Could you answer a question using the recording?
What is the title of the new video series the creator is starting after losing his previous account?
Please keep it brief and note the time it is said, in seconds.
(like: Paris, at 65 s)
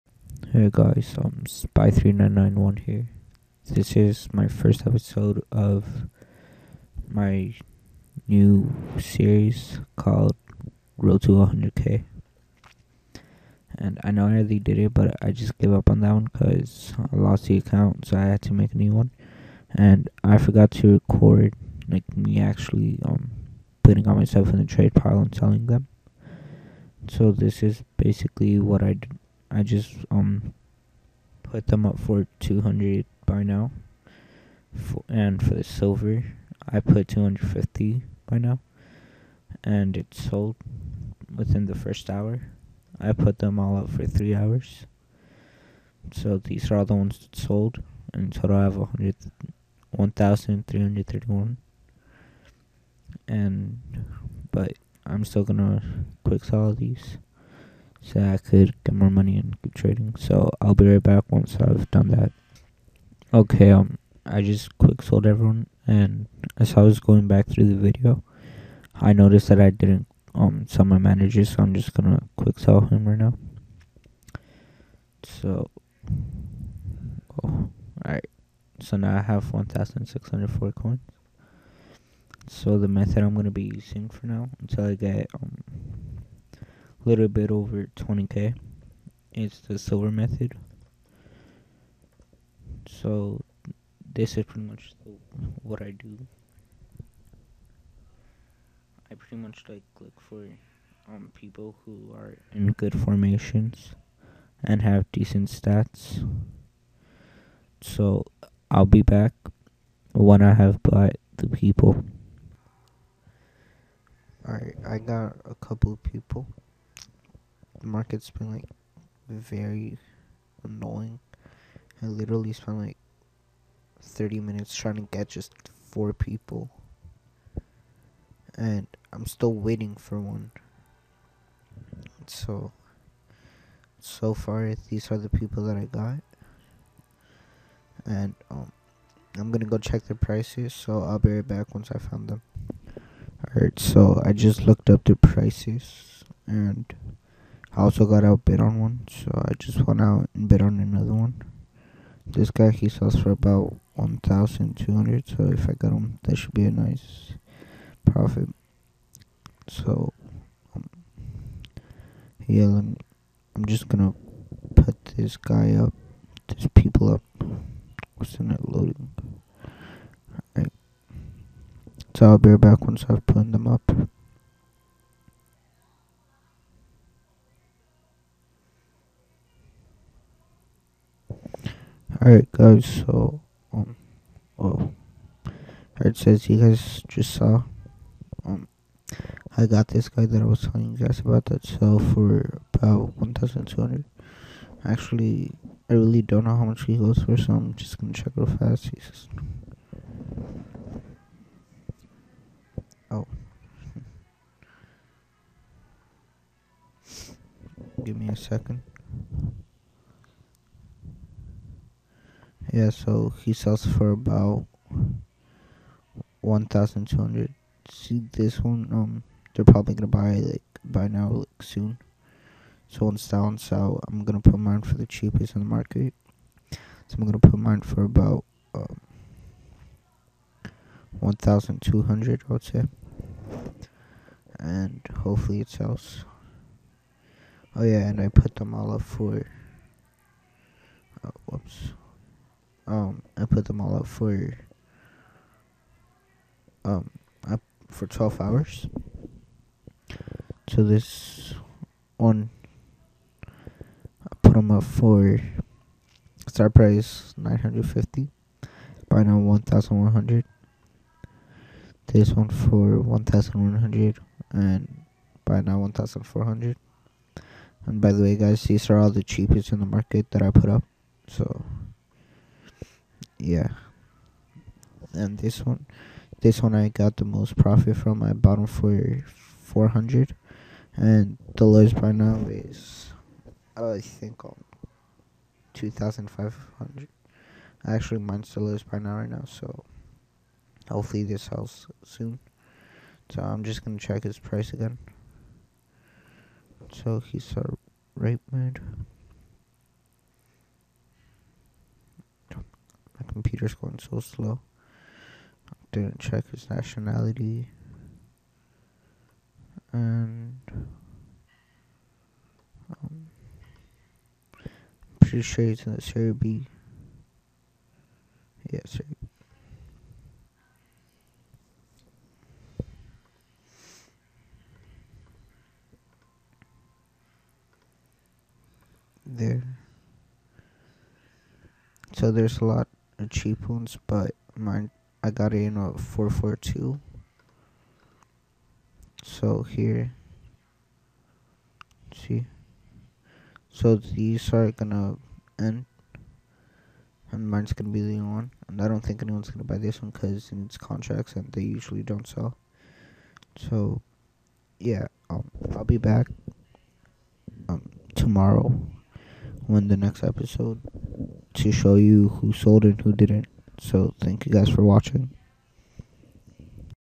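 Road to 100k, at 10 s.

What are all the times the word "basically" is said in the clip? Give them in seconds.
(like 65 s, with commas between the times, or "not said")
27 s.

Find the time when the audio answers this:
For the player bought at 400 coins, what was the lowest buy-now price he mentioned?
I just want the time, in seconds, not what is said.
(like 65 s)
285 s.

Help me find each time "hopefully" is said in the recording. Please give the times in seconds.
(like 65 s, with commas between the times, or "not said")
235 s, 290 s.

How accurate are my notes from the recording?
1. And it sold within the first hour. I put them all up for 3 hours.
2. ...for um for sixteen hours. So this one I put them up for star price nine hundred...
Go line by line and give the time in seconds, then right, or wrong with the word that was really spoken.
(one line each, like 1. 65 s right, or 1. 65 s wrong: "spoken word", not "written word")
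1. 39 s right
2. 244 s wrong: "twelve", not "sixteen".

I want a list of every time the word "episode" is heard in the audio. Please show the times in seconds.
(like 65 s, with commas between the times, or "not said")
4 s, 360 s.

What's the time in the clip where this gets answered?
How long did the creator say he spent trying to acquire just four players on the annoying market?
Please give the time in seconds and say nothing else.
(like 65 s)
124 s.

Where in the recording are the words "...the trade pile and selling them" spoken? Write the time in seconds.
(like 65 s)
24 s.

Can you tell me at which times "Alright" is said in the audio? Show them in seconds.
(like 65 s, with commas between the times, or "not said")
114 s, 143 s, 170 s, 182 s.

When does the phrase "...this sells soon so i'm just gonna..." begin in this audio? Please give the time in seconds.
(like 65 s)
291 s.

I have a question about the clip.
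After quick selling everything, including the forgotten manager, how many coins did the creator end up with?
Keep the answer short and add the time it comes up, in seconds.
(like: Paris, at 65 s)
1,604, at 79 s.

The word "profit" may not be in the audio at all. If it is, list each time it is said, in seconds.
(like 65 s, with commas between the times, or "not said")
158 s, 277 s.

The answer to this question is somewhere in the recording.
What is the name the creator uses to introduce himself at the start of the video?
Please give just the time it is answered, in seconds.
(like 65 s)
1 s.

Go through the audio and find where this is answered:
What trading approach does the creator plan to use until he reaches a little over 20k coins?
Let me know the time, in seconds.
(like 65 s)
89 s.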